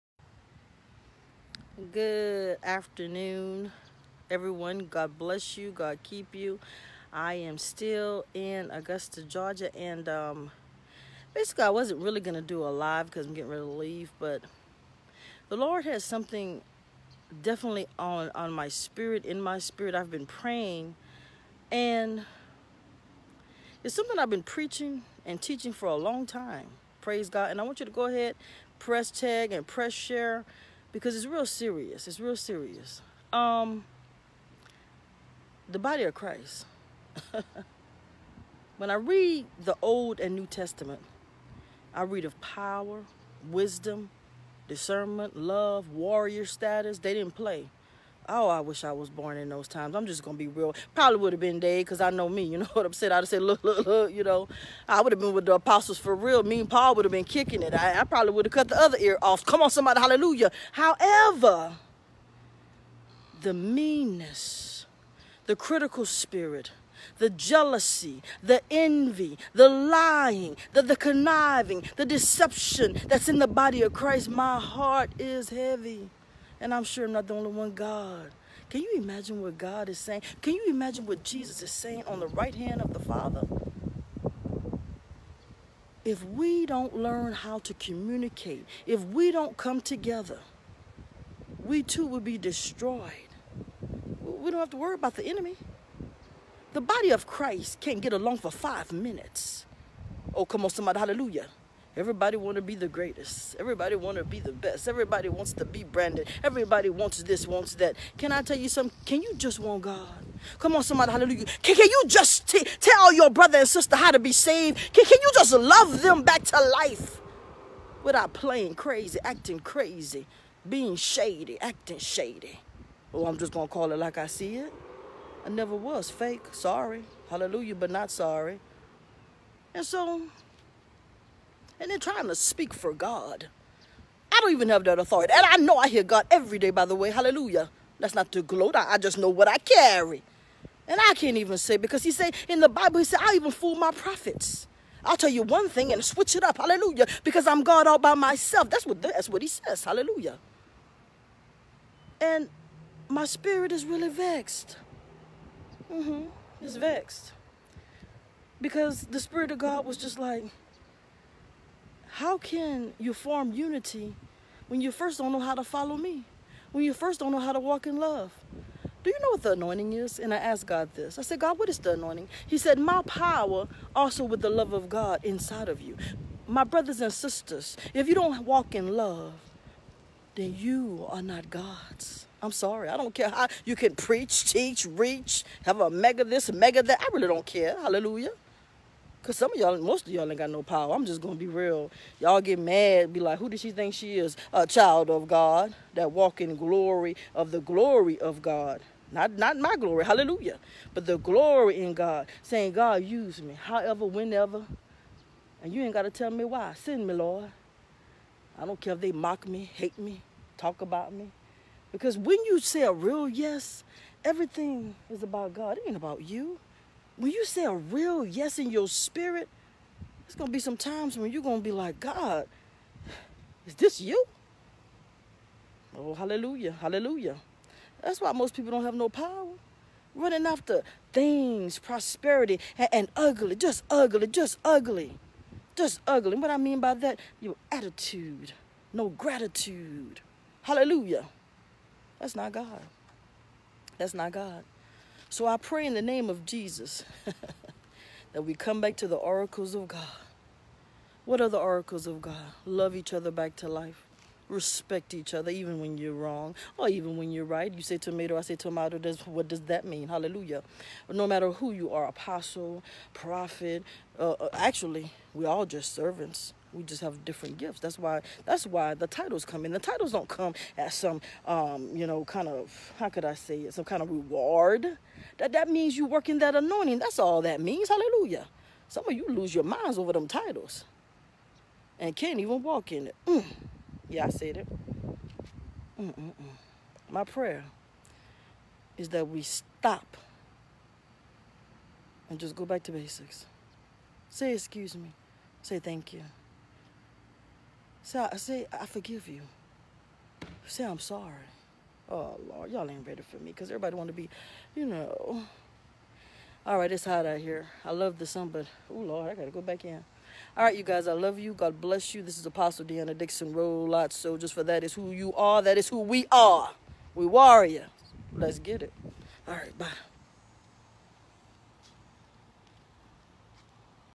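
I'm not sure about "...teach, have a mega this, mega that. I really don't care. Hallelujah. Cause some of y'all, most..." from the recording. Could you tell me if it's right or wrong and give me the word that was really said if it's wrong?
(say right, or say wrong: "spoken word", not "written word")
wrong: "reach", not "teach".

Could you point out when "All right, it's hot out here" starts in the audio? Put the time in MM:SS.
05:06.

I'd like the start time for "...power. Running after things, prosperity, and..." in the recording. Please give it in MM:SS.
03:49.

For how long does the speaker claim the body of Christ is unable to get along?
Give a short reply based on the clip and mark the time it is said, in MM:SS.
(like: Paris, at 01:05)
5 minutes, at 01:38.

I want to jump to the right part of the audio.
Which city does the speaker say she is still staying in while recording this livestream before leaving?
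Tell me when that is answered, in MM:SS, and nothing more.
00:08.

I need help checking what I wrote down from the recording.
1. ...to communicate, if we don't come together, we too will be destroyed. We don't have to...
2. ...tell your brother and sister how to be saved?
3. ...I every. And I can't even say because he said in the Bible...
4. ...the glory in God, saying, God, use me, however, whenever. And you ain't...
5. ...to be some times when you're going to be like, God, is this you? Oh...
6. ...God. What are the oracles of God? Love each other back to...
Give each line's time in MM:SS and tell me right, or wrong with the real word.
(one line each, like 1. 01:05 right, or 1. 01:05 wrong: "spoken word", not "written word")
1. 01:27 right
2. 01:52 right
3. 02:19 wrong: "carry", not "every"
4. 03:21 right
5. 03:40 right
6. 04:09 right.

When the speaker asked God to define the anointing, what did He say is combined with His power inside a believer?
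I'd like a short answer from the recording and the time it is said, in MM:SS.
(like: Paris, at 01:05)
the love of God, at 02:54.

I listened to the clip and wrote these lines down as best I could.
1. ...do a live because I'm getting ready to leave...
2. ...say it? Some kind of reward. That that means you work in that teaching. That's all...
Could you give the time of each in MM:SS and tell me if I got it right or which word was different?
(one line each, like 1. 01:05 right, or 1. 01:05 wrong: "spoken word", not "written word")
1. 00:12 right
2. 04:33 wrong: "anointing", not "teaching".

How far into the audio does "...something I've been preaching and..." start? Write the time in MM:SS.
00:23.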